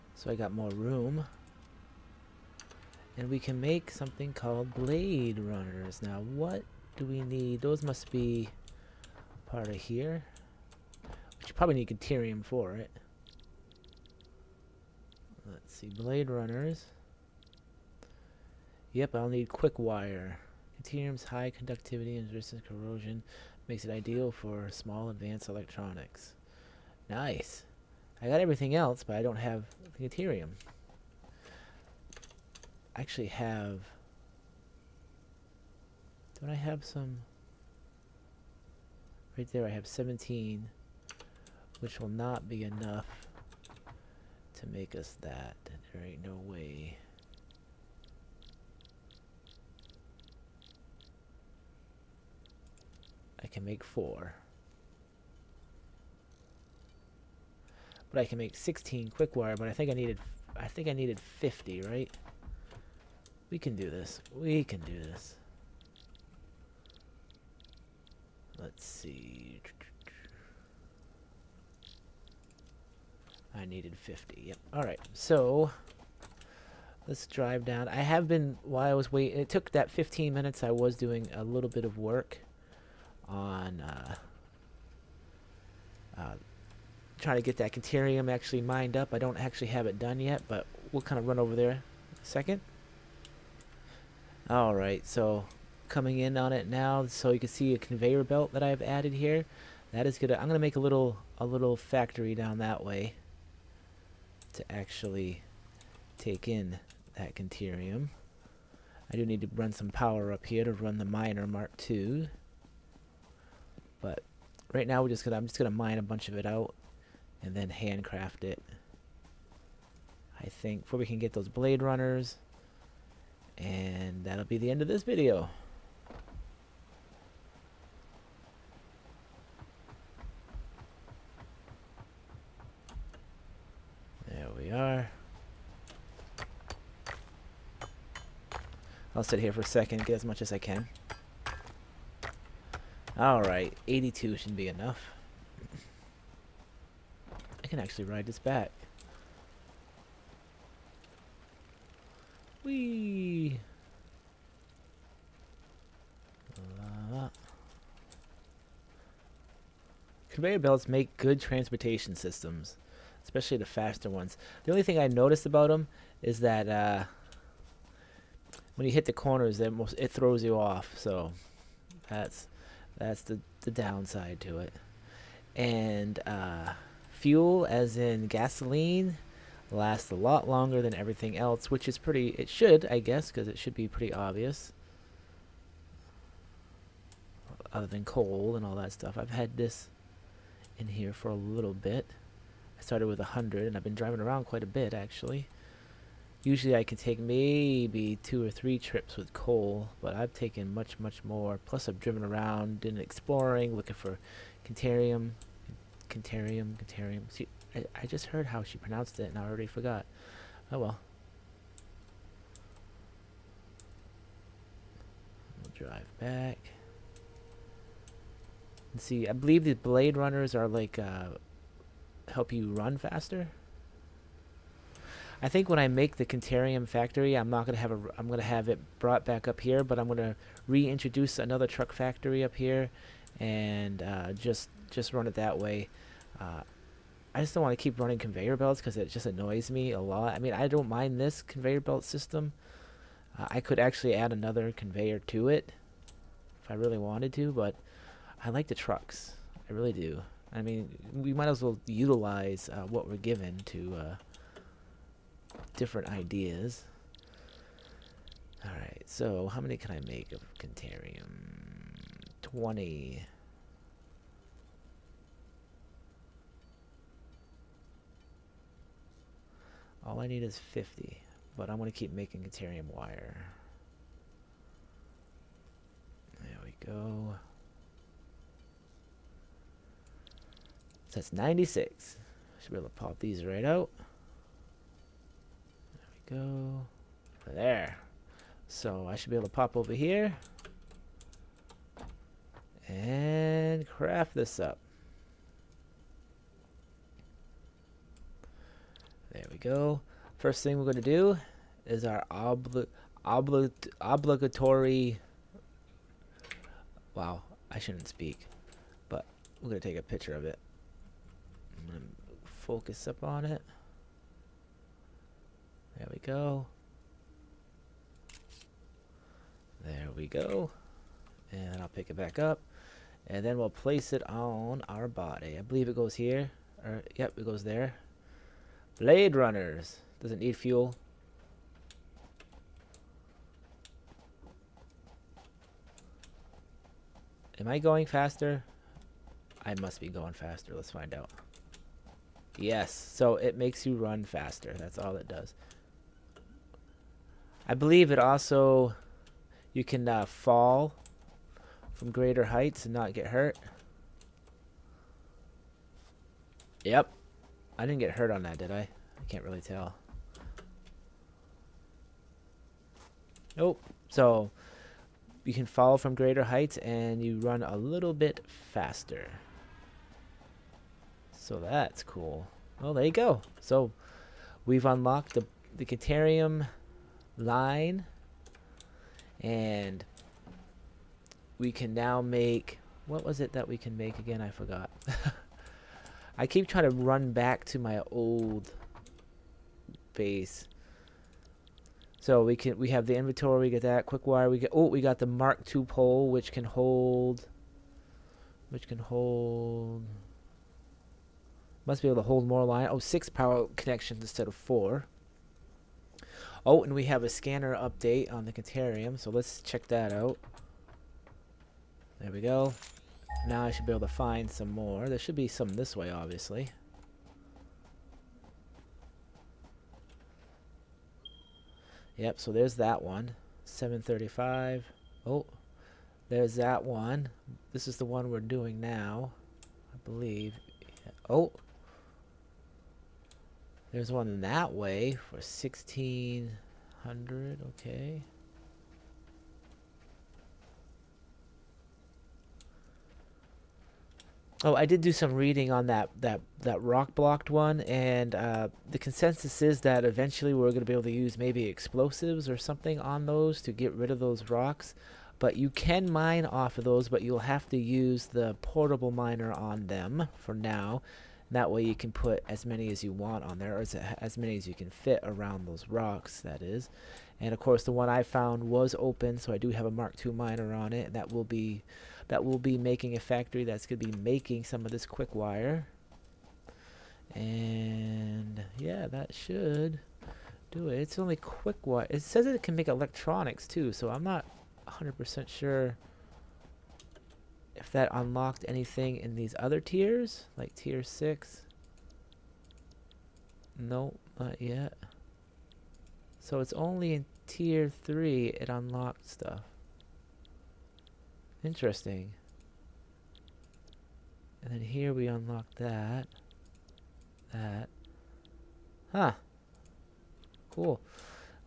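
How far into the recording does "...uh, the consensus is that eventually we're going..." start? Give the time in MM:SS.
07:28.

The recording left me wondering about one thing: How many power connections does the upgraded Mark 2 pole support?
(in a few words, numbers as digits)
6.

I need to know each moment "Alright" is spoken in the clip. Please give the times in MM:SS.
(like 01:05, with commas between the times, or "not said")
02:23, 04:18.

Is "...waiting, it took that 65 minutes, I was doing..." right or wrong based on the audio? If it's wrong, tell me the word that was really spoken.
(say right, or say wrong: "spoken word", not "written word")
wrong: "15", not "65".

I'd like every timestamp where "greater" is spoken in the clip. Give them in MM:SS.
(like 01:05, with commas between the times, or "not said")
05:52, 06:06.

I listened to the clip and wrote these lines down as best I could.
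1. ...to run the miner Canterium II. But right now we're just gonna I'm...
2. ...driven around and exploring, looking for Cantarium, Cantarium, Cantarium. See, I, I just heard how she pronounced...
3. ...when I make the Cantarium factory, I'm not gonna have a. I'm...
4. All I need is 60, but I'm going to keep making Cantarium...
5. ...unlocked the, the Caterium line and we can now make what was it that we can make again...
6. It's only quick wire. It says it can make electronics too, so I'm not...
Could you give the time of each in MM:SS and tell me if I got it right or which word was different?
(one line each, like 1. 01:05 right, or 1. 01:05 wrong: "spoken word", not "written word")
1. 01:50 wrong: "Mark", not "Canterium"
2. 03:21 right
3. 03:45 right
4. 04:30 wrong: "50", not "60"
5. 06:14 right
6. 08:00 right.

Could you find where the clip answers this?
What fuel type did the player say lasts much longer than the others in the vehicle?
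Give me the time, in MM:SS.
02:58.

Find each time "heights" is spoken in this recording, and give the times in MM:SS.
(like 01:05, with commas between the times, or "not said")
05:52, 06:06.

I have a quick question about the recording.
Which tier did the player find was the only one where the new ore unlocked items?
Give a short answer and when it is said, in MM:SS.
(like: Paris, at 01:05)
tier 3, at 08:17.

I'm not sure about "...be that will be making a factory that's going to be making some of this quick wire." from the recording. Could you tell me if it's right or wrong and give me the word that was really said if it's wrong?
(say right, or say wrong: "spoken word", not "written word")
right.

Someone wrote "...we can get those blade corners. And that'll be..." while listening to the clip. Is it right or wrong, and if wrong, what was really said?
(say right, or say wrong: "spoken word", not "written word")
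wrong: "runners", not "corners".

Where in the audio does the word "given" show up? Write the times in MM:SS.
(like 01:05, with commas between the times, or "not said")
04:13.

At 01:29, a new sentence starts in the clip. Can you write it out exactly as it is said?
I don't actually have it done yet, but we'll kind of run over there a second.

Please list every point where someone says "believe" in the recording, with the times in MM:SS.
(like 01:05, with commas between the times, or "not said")
03:39, 05:25, 05:47, 07:10.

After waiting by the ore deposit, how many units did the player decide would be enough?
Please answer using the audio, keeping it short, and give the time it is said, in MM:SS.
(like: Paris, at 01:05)
82, at 02:23.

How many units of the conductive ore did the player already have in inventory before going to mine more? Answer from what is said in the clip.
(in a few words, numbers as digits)
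17.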